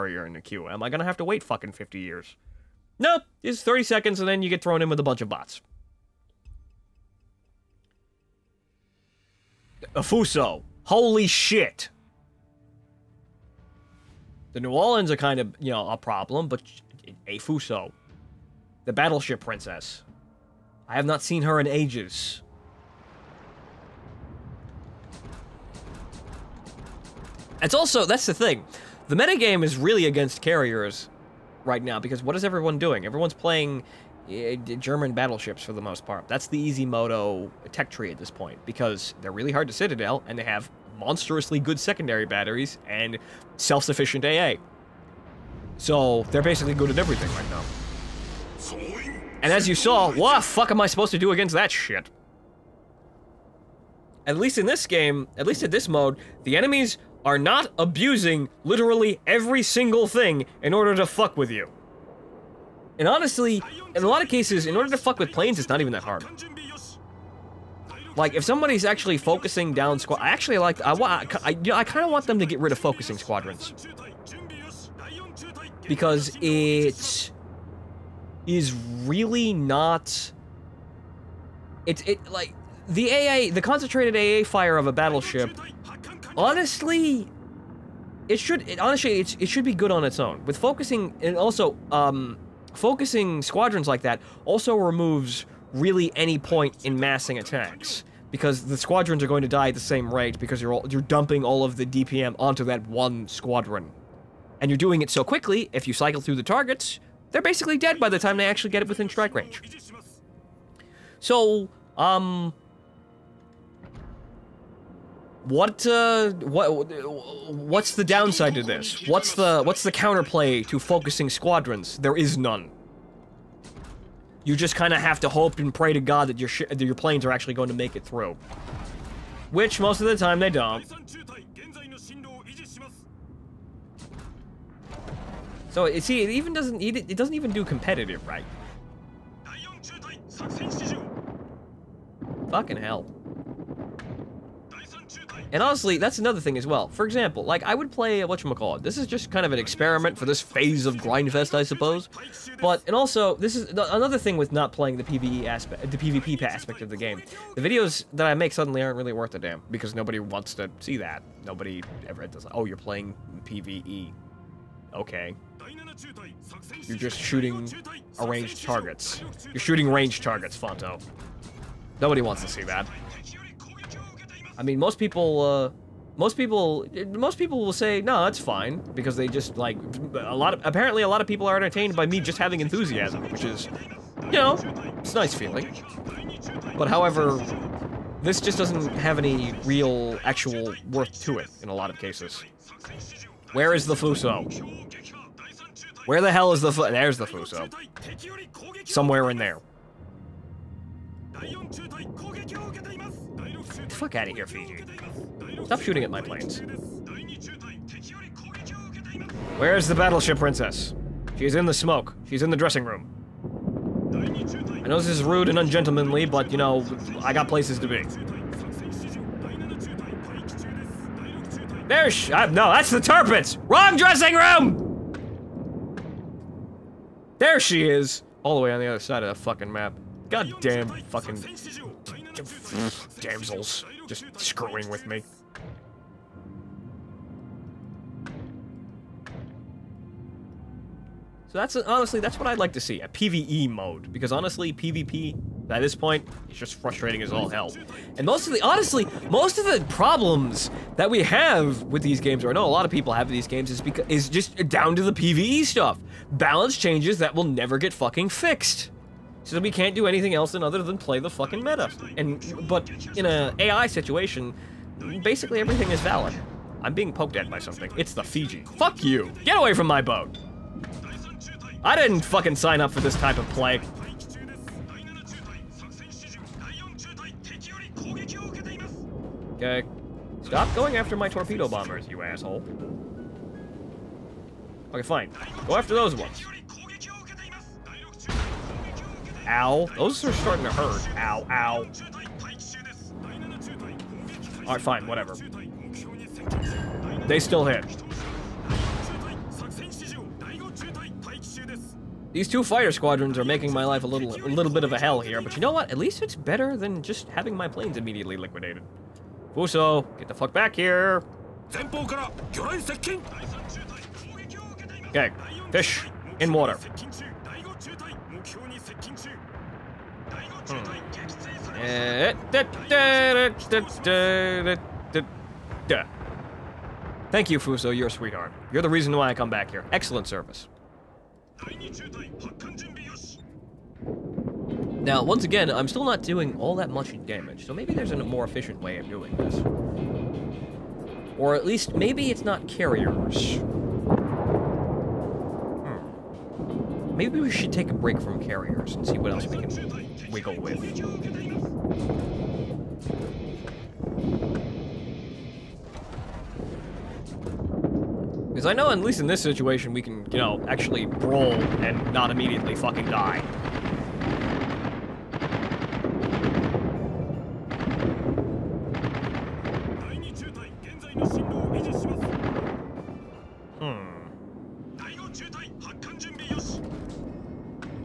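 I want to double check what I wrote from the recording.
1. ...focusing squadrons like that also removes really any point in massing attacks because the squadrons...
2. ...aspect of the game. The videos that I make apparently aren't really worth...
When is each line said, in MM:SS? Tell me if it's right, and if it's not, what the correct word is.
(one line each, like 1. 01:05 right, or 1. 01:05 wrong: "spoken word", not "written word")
1. 01:32 right
2. 02:36 wrong: "suddenly", not "apparently".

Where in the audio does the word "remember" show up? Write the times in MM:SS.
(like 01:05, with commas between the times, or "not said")
not said.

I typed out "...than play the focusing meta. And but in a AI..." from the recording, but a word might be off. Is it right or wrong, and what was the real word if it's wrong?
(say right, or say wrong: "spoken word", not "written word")
wrong: "fucking", not "focusing".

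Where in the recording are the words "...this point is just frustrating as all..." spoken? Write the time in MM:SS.
04:05.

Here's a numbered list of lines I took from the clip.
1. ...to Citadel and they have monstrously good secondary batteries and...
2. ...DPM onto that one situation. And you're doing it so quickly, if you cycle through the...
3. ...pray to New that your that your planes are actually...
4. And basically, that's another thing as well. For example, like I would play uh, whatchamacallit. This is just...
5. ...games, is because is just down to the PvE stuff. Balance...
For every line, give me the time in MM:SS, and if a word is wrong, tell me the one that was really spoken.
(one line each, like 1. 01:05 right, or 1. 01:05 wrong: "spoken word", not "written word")
1. 00:39 right
2. 01:41 wrong: "squadron", not "situation"
3. 02:05 wrong: "God", not "New"
4. 02:25 wrong: "honestly", not "basically"
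5. 04:13 right.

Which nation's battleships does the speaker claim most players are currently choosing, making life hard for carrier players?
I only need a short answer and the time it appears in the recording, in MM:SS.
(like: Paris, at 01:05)
German, at 00:34.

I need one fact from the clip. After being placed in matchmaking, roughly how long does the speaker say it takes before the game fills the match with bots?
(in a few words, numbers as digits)
30 seconds.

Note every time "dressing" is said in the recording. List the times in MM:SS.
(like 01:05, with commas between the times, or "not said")
03:32, 03:43.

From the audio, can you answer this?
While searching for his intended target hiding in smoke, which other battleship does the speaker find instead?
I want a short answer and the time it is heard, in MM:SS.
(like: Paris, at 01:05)
Tirpitz, at 03:42.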